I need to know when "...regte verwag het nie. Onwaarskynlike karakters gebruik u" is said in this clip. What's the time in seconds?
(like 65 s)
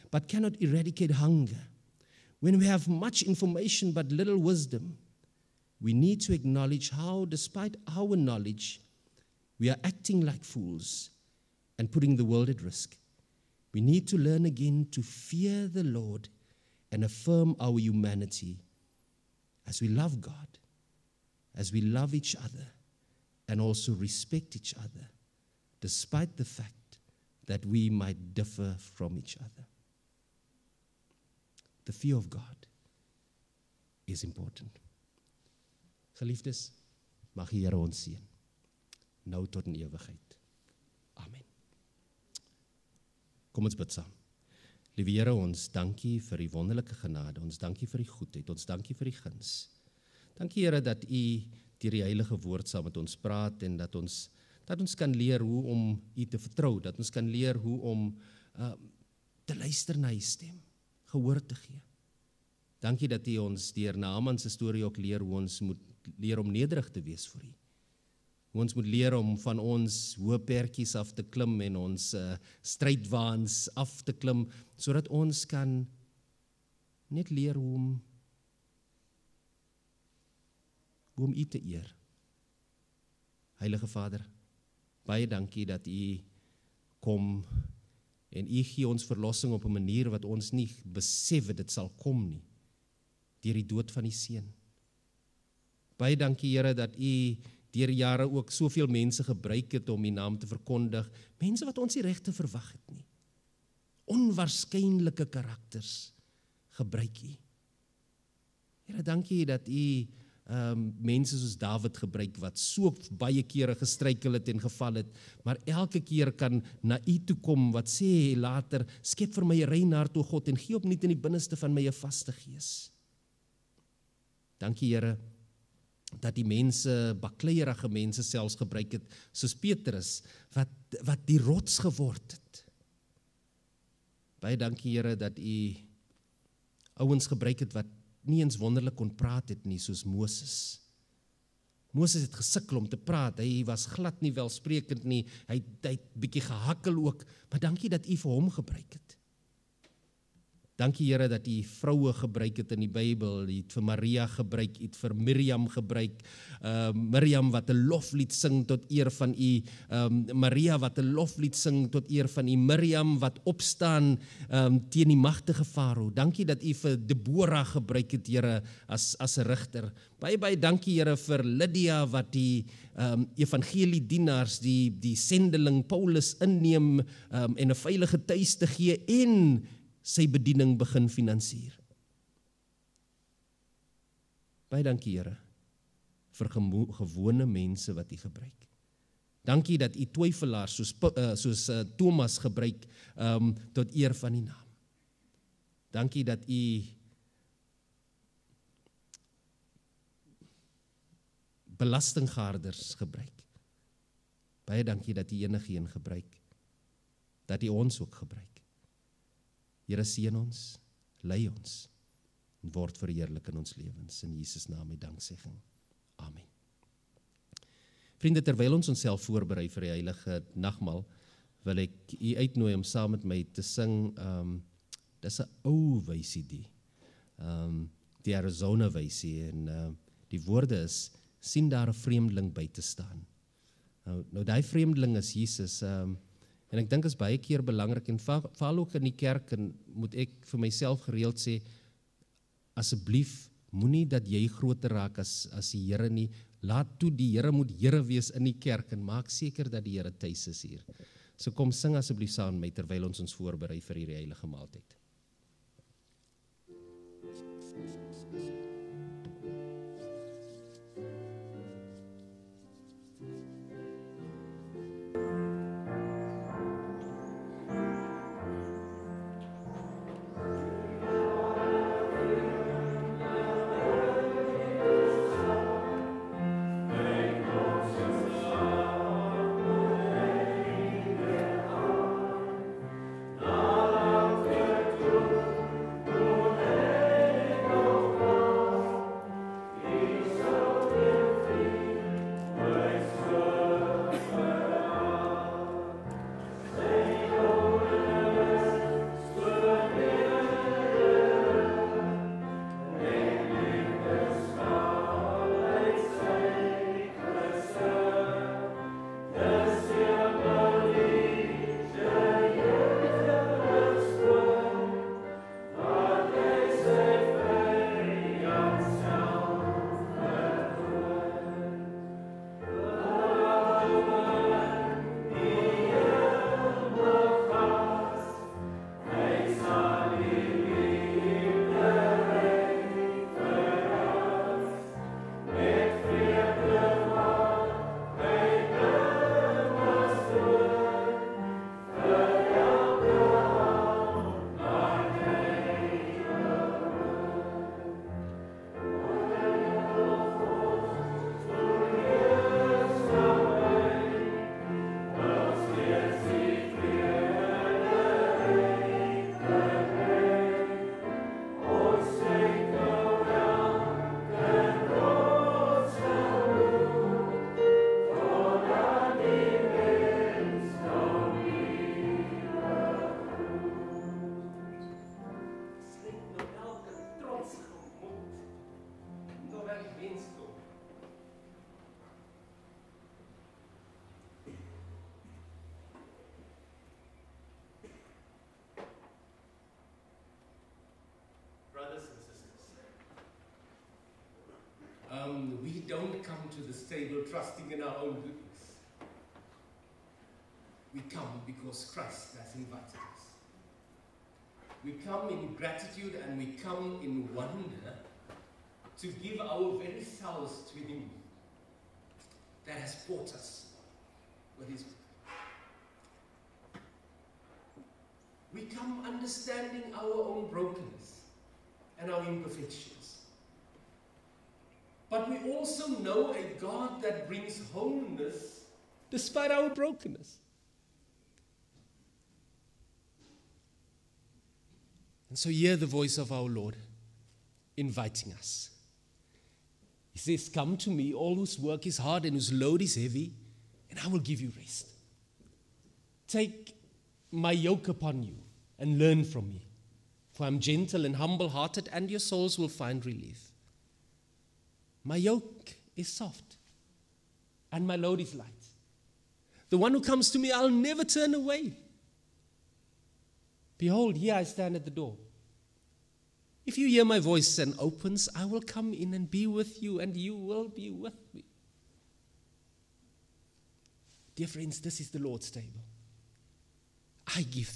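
102 s.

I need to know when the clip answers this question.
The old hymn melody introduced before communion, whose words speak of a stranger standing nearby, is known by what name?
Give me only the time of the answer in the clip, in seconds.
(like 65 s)
228 s.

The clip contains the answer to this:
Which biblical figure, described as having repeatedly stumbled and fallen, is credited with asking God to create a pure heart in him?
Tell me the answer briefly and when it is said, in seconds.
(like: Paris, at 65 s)
Dawid, at 111 s.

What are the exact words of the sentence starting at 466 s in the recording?
If you hear my voice and opens, I will come in and be with you, and you will be with me.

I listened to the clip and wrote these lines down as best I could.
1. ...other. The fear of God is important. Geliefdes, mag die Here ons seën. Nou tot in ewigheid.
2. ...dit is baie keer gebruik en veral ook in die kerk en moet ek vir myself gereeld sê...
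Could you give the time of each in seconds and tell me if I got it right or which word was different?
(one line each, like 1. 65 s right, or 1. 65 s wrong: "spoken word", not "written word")
1. 29 s right
2. 237 s wrong: "belangrik", not "gebruik".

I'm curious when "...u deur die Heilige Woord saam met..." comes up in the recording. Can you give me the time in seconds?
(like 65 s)
51 s.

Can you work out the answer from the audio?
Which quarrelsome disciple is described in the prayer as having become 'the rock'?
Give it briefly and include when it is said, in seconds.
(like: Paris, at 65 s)
Petrus, at 129 s.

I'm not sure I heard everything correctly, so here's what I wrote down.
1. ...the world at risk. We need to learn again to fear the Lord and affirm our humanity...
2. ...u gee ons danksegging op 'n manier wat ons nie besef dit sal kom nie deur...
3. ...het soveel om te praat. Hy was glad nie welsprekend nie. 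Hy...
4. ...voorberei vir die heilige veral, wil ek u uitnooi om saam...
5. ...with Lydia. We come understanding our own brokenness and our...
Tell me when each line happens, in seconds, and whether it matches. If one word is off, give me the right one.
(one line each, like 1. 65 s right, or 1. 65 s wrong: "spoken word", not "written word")
1. 12 s right
2. 88 s wrong: "verlossing", not "danksegging"
3. 142 s wrong: "gesukkel", not "soveel"
4. 219 s wrong: "nagmaal", not "veral"
5. 414 s wrong: "His", not "Lydia".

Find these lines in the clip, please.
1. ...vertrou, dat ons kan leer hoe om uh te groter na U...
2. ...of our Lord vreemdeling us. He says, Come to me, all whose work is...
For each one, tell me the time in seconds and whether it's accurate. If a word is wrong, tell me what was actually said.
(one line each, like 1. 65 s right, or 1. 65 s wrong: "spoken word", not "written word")
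1. 56 s wrong: "luister", not "groter"
2. 436 s wrong: "inviting", not "vreemdeling".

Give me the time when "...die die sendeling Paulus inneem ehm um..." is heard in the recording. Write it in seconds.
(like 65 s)
174 s.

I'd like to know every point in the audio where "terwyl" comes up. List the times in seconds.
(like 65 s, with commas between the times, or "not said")
218 s, 252 s.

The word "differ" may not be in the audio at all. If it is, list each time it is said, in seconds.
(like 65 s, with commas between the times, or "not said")
28 s.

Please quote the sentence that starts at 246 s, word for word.
Laat toe die Here moet Here wees in die kerk en maak seker dat die Here tuis is hier.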